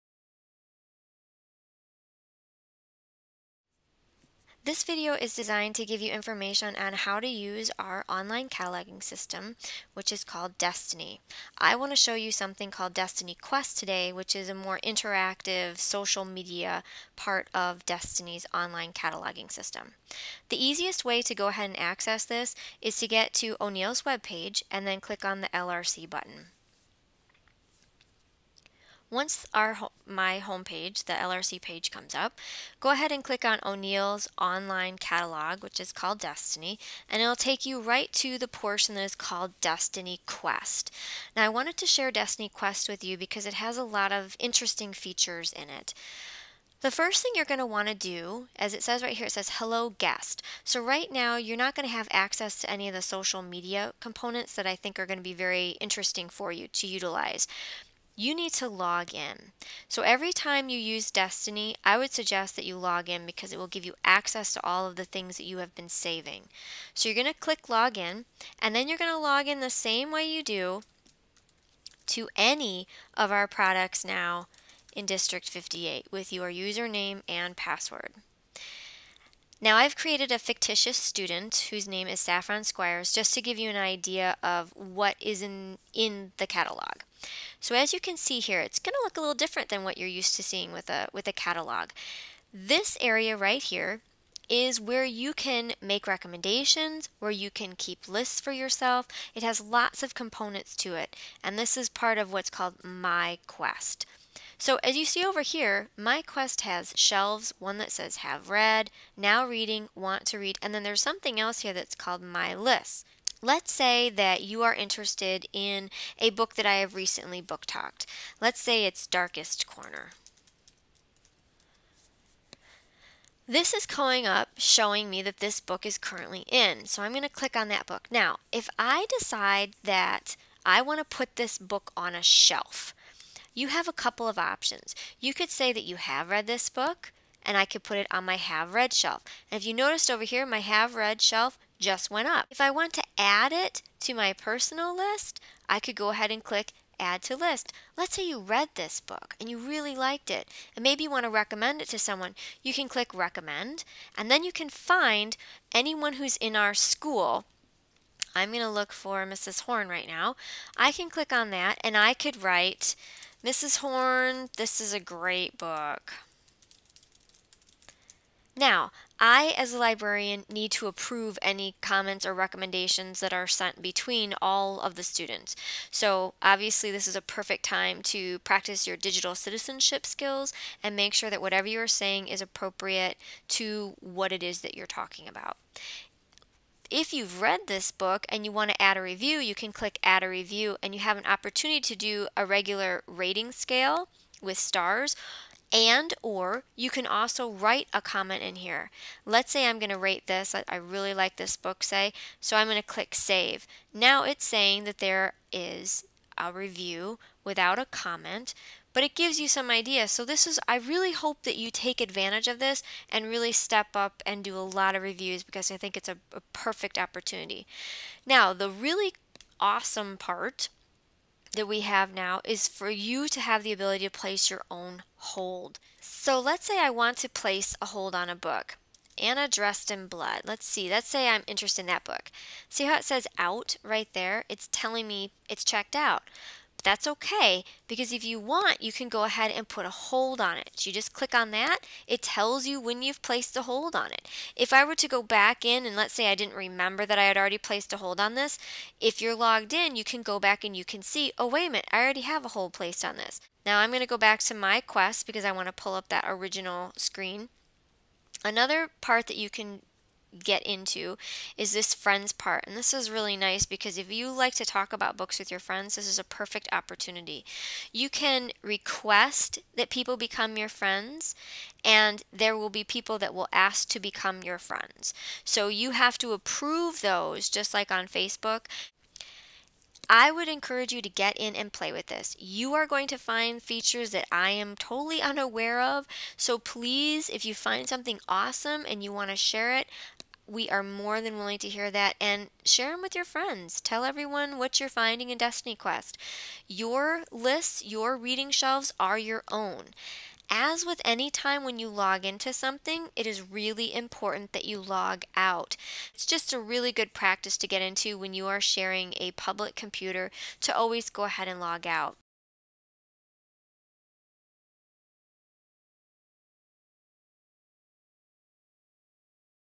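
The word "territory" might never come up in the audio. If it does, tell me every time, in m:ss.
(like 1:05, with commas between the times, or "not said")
not said.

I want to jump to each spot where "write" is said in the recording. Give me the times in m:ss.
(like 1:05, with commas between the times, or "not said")
2:42, 3:17.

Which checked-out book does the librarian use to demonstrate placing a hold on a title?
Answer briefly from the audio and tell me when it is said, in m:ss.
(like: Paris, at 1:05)
Anna Dressed in Blood, at 3:49.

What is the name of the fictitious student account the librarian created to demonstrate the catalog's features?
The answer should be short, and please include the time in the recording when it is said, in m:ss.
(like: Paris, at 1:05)
Saffron Squires, at 1:22.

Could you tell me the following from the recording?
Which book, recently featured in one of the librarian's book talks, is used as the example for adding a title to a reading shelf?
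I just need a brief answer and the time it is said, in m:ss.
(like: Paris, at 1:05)
Darkest Corner, at 1:59.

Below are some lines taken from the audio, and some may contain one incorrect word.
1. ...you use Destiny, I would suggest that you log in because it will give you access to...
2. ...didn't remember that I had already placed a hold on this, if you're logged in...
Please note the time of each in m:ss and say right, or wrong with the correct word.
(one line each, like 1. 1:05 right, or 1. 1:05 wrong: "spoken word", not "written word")
1. 1:00 right
2. 4:06 right.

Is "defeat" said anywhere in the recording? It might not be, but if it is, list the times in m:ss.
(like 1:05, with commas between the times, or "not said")
not said.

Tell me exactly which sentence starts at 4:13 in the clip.
Now I'm going to go back to my quest because I want to pull up that original screen.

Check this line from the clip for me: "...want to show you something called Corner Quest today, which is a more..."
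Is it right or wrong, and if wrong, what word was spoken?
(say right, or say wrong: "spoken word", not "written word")
wrong: "Destiny", not "Corner".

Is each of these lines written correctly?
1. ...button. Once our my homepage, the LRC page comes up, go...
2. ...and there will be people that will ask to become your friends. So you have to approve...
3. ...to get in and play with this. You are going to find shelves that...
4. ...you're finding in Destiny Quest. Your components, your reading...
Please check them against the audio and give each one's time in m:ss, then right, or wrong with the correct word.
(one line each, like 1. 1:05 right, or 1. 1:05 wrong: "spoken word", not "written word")
1. 0:26 right
2. 4:31 right
3. 4:41 wrong: "features", not "shelves"
4. 4:54 wrong: "lists", not "components".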